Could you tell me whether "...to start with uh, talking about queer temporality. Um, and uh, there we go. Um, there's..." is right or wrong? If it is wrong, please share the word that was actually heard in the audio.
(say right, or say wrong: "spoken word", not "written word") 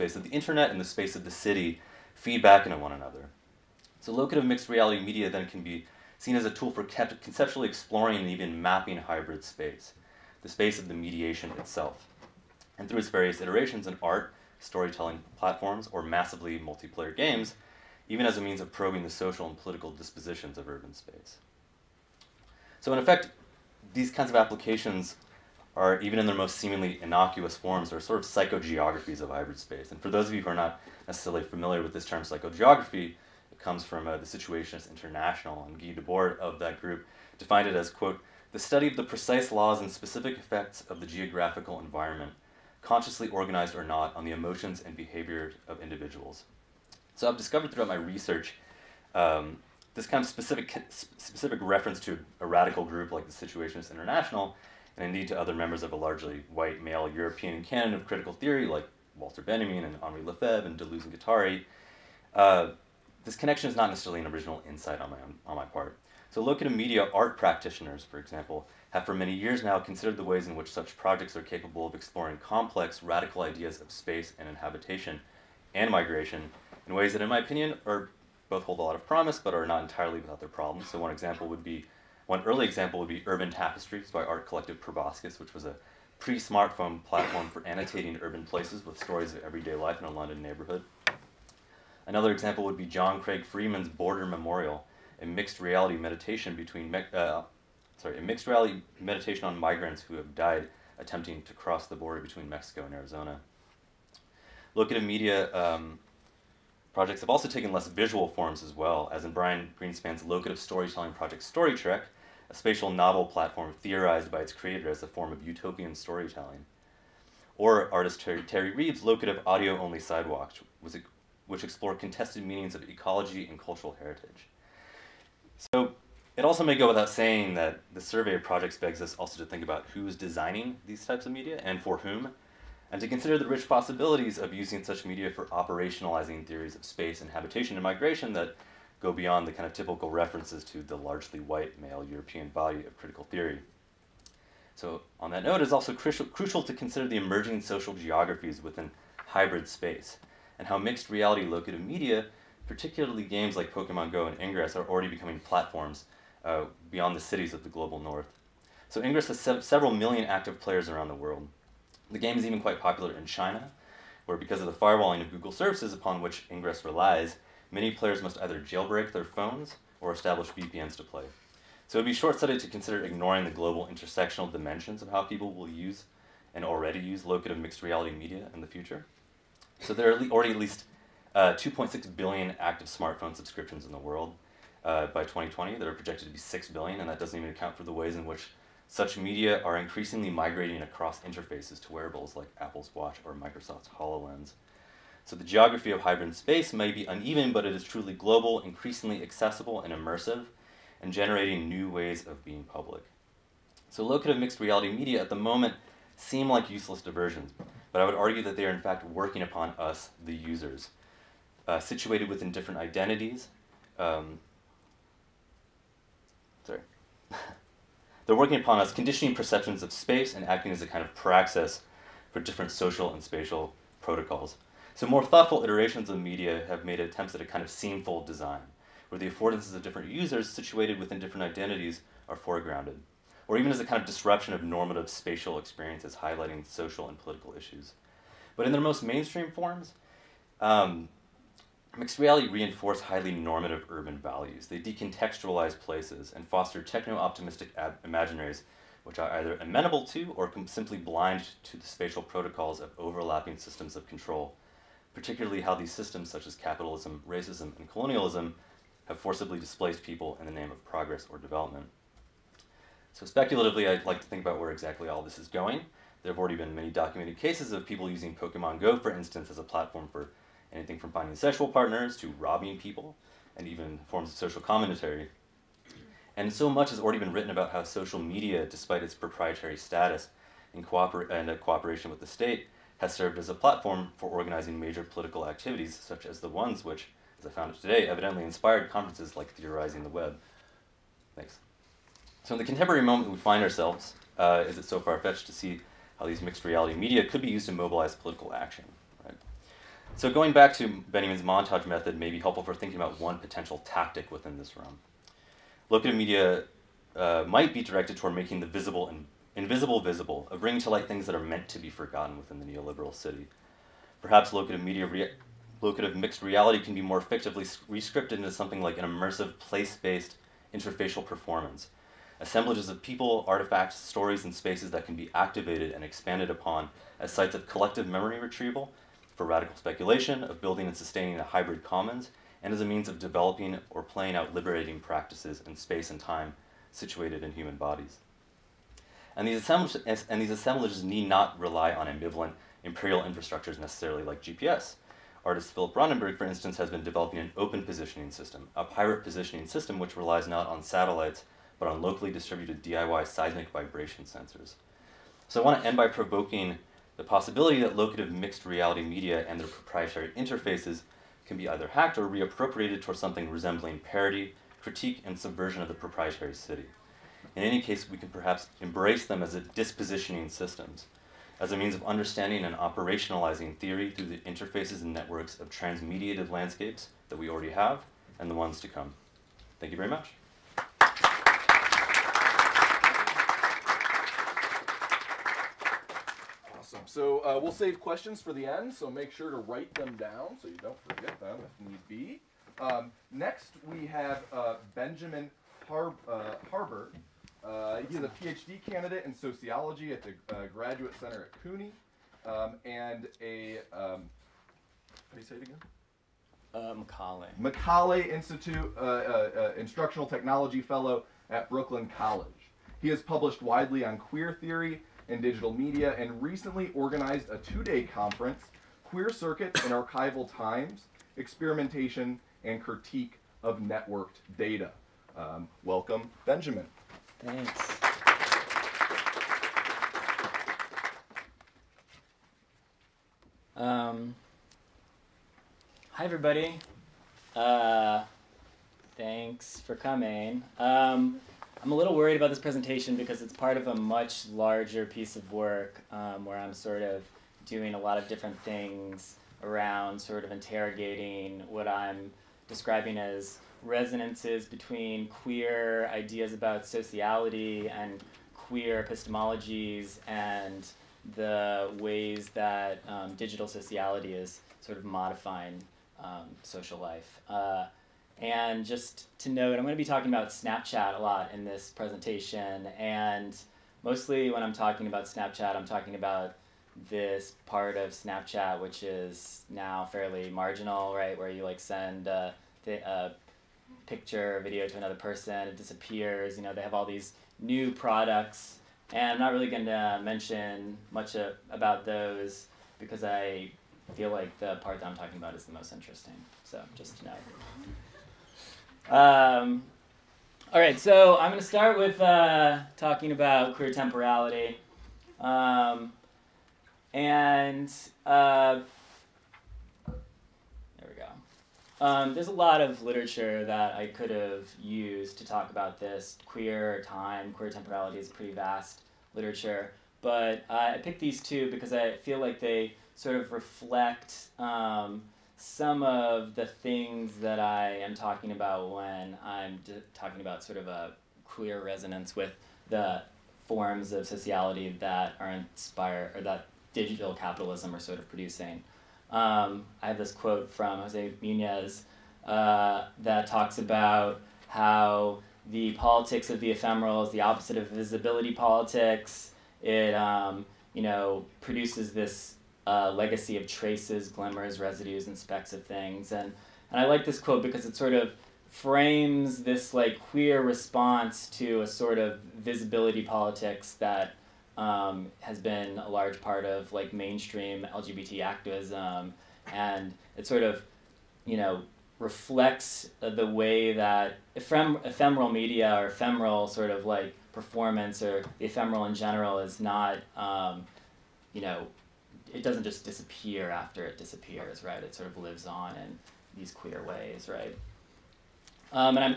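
right.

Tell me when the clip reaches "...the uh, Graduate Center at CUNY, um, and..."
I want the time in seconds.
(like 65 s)
400 s.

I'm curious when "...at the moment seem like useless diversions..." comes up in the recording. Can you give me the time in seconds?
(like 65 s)
205 s.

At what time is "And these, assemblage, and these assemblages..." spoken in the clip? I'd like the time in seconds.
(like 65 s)
339 s.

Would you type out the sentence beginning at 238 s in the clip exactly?
But in their most mainstream forms, um, Mixed reality reinforce highly normative urban values.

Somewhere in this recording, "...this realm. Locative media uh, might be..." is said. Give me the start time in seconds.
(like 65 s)
304 s.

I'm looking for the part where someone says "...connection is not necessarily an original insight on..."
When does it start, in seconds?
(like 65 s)
63 s.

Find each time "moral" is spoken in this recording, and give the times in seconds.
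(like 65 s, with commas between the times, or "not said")
not said.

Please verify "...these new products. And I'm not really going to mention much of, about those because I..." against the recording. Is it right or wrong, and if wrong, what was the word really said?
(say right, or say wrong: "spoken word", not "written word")
right.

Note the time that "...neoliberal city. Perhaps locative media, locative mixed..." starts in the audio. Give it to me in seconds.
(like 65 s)
312 s.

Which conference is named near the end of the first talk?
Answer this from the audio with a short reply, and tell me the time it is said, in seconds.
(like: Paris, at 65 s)
Theorizing the Web, at 289 s.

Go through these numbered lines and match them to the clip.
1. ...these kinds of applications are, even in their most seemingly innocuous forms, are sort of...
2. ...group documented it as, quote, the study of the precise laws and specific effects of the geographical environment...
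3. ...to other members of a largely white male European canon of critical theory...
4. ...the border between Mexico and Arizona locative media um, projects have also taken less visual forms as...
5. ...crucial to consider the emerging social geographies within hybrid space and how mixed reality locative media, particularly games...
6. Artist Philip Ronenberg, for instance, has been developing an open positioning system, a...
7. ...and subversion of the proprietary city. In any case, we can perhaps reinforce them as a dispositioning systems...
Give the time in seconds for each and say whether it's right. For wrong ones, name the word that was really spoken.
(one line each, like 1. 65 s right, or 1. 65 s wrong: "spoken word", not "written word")
1. 23 s right
2. 36 s wrong: "defined", not "documented"
3. 55 s right
4. 101 s right
5. 146 s right
6. 345 s right
7. 365 s wrong: "embrace", not "reinforce".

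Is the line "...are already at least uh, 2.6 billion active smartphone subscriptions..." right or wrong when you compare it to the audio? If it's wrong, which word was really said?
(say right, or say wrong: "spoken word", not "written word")
right.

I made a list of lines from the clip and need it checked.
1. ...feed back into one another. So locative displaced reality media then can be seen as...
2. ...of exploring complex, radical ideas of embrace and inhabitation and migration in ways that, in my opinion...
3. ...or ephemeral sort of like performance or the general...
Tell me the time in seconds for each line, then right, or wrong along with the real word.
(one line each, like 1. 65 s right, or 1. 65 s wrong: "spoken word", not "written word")
1. 2 s wrong: "mixed", not "displaced"
2. 71 s wrong: "space", not "embrace"
3. 575 s wrong: "ephemeral", not "general".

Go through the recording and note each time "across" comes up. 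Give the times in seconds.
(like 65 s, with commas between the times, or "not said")
190 s.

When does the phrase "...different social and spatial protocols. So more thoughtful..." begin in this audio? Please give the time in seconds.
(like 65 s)
222 s.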